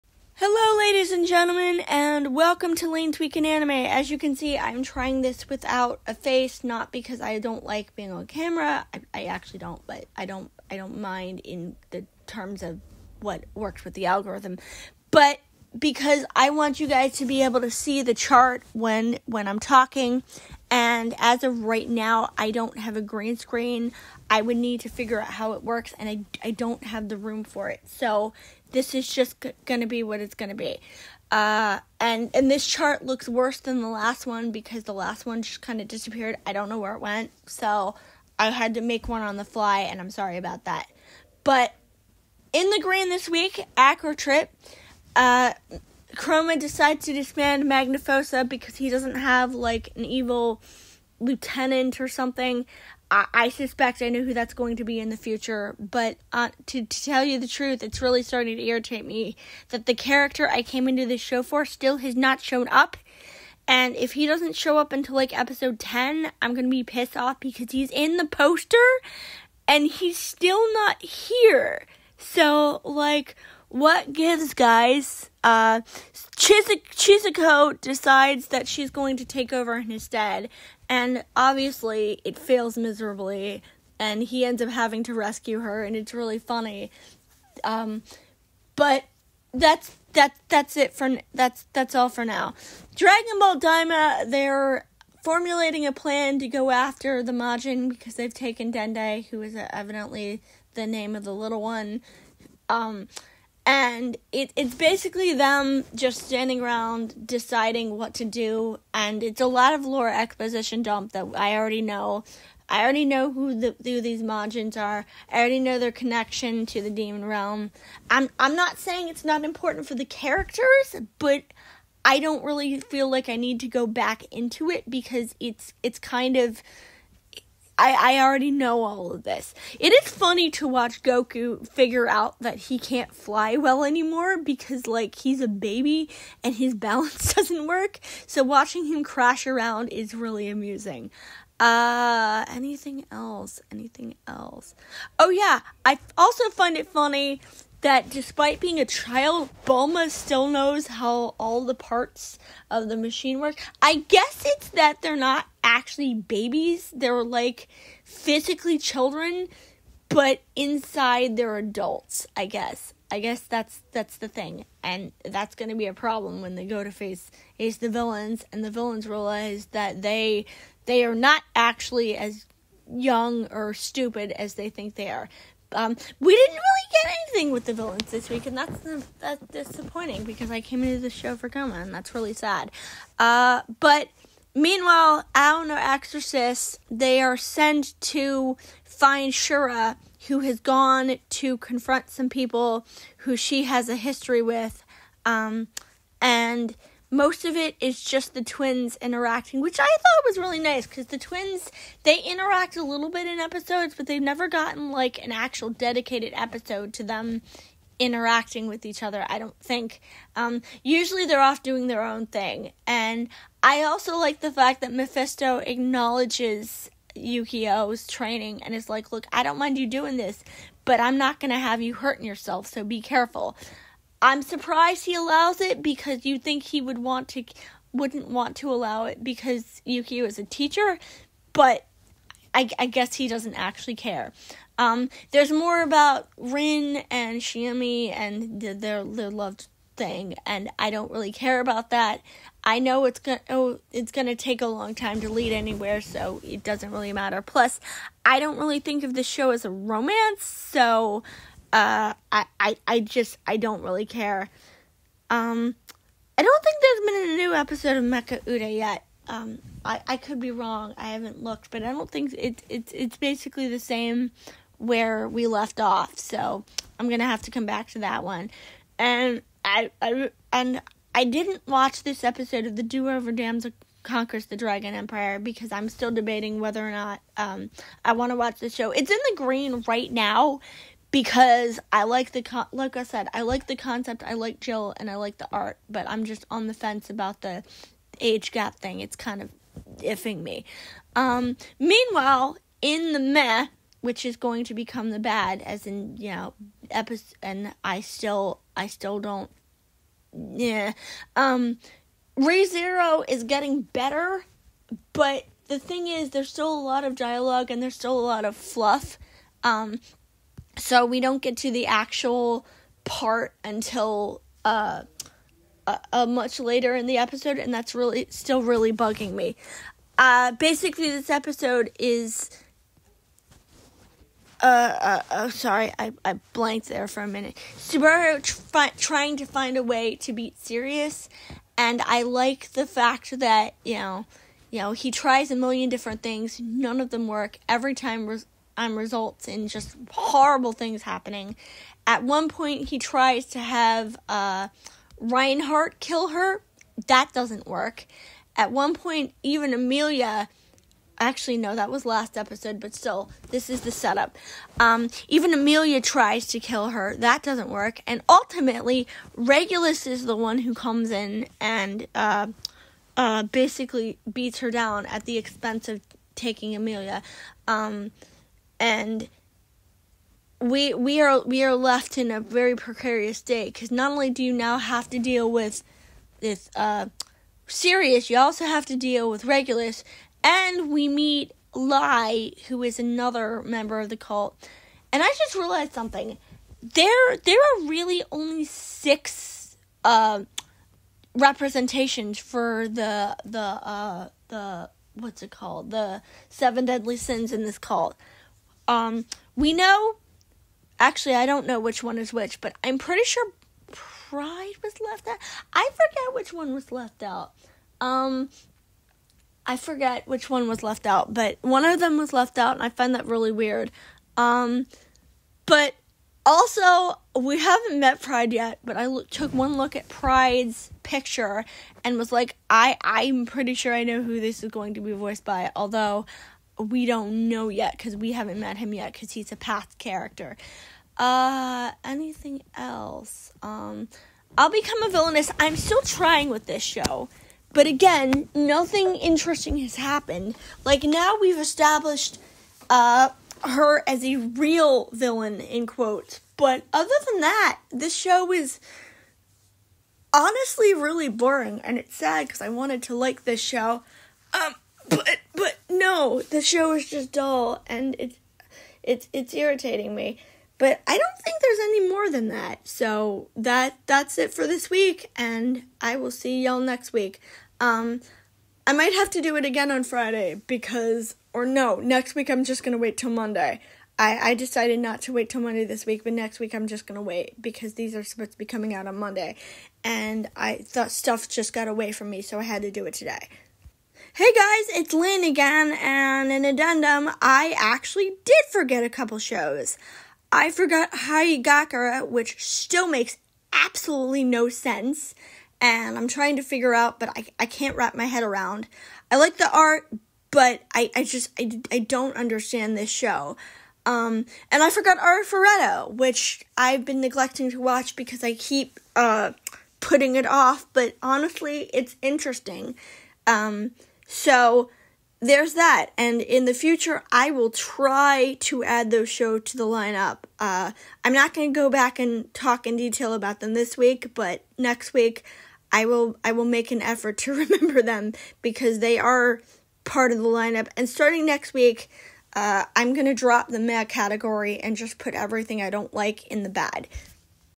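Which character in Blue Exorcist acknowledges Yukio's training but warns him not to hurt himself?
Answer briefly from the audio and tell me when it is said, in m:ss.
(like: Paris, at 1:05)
Mephisto, at 3:34.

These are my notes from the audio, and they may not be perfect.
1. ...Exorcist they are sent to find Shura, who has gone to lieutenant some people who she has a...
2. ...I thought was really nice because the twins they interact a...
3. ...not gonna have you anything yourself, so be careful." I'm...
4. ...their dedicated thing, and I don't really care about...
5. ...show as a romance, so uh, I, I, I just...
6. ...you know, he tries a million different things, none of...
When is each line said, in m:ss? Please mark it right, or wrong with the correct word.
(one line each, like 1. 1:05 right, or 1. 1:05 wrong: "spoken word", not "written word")
1. 3:05 wrong: "confront", not "lieutenant"
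2. 3:19 right
3. 3:41 wrong: "hurting", not "anything"
4. 3:59 wrong: "loved", not "dedicated"
5. 4:09 right
6. 5:34 right.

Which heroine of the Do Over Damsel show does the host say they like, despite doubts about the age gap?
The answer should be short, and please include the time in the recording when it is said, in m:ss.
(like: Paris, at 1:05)
Jill, at 4:44.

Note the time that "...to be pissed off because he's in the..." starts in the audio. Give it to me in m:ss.
1:06.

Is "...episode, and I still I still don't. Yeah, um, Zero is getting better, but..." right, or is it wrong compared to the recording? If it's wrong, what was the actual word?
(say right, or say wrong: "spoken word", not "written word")
right.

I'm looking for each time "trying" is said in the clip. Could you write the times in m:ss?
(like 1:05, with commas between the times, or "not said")
0:04, 5:28, 7:16, 8:16.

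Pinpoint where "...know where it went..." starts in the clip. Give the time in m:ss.
0:36.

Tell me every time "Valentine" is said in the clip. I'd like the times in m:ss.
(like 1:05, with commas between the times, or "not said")
not said.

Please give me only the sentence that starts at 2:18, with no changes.
So, watching him crash around is really amusing.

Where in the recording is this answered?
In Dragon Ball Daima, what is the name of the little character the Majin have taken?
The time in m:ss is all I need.
1:38.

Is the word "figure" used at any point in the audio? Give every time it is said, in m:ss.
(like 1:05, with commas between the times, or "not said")
0:24, 2:11, 8:16.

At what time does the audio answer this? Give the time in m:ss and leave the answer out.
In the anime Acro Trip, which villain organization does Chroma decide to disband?
0:47.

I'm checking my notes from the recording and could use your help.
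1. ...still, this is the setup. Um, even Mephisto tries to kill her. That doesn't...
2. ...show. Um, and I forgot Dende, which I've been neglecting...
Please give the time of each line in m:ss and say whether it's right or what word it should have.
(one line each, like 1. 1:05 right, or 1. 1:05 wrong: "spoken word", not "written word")
1. 5:52 wrong: "Emilia", not "Mephisto"
2. 8:23 wrong: "Arifureta", not "Dende".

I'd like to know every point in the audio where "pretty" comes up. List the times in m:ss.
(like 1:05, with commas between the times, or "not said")
6:42, 7:03.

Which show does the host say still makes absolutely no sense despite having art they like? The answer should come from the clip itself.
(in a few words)
Haigakura.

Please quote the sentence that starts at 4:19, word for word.
Um, I, I could be wrong.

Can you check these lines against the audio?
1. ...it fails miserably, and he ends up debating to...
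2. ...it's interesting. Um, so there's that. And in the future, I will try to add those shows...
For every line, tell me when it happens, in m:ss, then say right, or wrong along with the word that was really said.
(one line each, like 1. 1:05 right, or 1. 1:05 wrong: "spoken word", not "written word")
1. 1:22 wrong: "having", not "debating"
2. 8:31 right.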